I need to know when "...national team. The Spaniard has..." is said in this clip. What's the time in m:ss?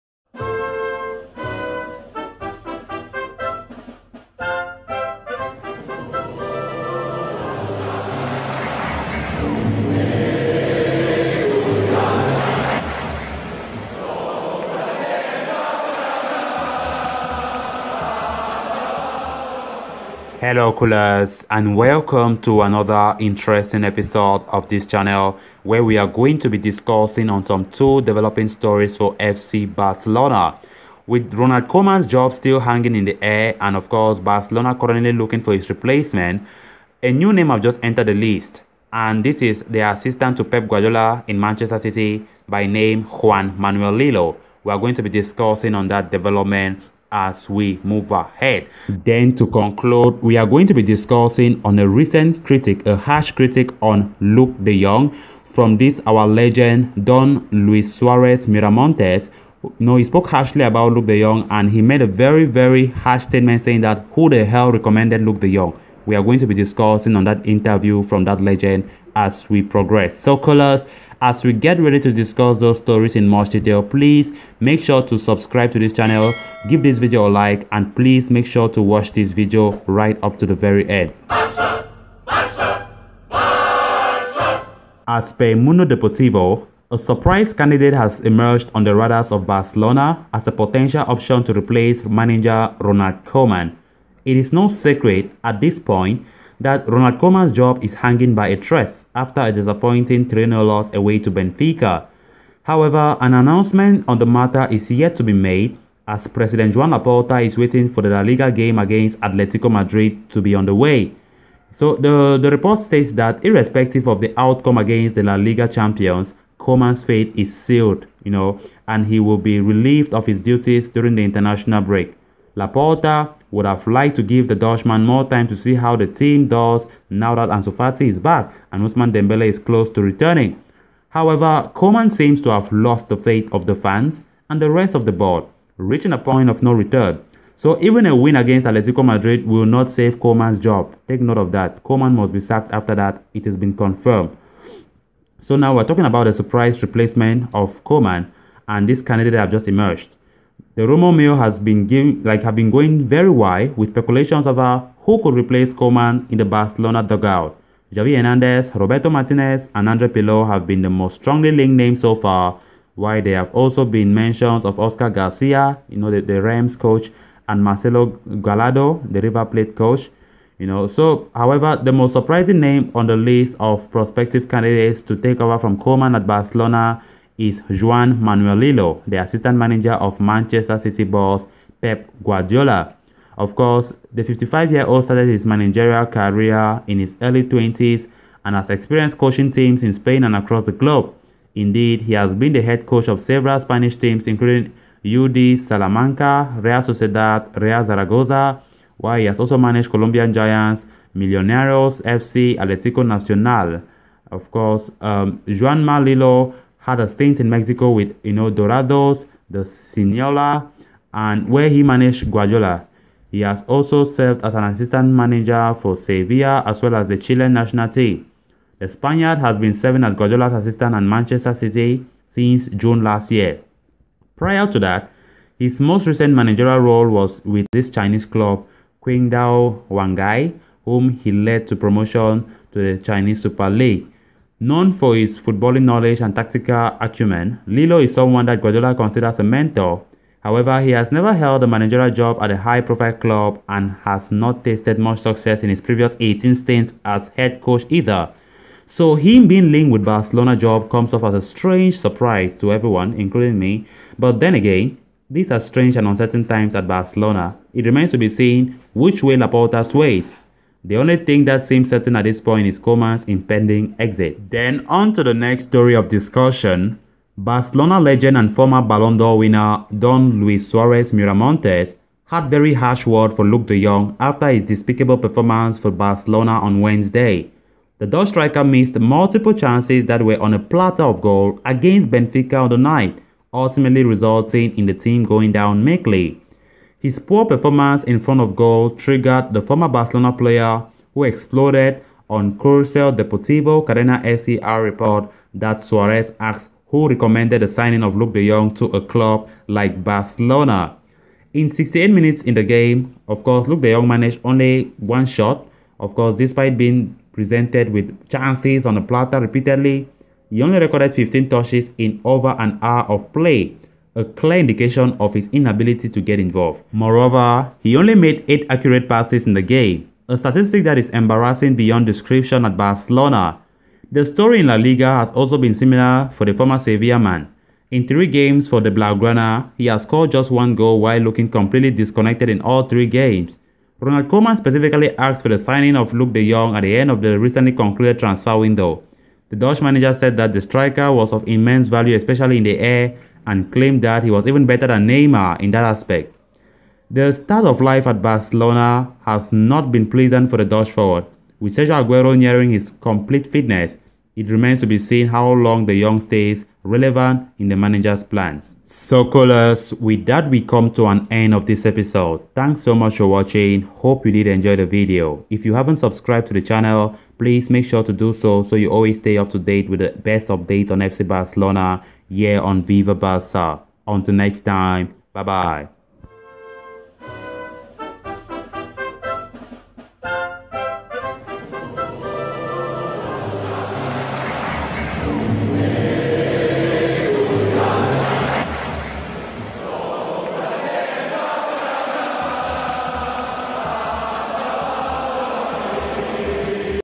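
3:37.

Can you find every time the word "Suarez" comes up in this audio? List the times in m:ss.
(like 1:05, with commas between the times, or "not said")
0:57, 4:30, 4:55.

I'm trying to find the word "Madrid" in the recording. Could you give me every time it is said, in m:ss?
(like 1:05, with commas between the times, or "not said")
1:49, 2:19.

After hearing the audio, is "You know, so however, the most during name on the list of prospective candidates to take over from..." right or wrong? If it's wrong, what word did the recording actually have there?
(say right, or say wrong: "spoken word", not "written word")
wrong: "surprising", not "during".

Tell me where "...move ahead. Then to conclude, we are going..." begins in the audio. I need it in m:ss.
0:47.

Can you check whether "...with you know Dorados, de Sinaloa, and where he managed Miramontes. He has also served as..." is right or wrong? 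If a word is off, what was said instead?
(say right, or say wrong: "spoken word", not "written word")
wrong: "Guardiola", not "Miramontes".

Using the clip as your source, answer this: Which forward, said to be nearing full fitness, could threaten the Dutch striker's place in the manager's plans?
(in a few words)
Sergio Aguero.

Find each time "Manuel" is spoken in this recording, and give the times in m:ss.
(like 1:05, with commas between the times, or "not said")
0:43, 2:58.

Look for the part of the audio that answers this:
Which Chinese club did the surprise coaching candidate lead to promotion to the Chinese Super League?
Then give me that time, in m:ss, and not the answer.
3:49.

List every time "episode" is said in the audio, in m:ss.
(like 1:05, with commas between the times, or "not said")
0:23, 6:01.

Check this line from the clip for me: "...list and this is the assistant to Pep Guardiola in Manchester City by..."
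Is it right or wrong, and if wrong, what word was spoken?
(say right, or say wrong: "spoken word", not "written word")
right.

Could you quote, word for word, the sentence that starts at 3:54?
Known for his footballing knowledge and tactical acumen, Lillo is someone that Guardiola considers a mentor.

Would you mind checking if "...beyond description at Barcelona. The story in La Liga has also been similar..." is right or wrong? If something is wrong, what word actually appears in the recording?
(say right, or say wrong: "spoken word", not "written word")
right.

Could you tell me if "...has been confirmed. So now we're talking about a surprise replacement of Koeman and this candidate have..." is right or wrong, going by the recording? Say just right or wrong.
right.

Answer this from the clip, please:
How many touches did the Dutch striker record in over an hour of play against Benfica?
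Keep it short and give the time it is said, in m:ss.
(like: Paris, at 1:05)
15, at 5:11.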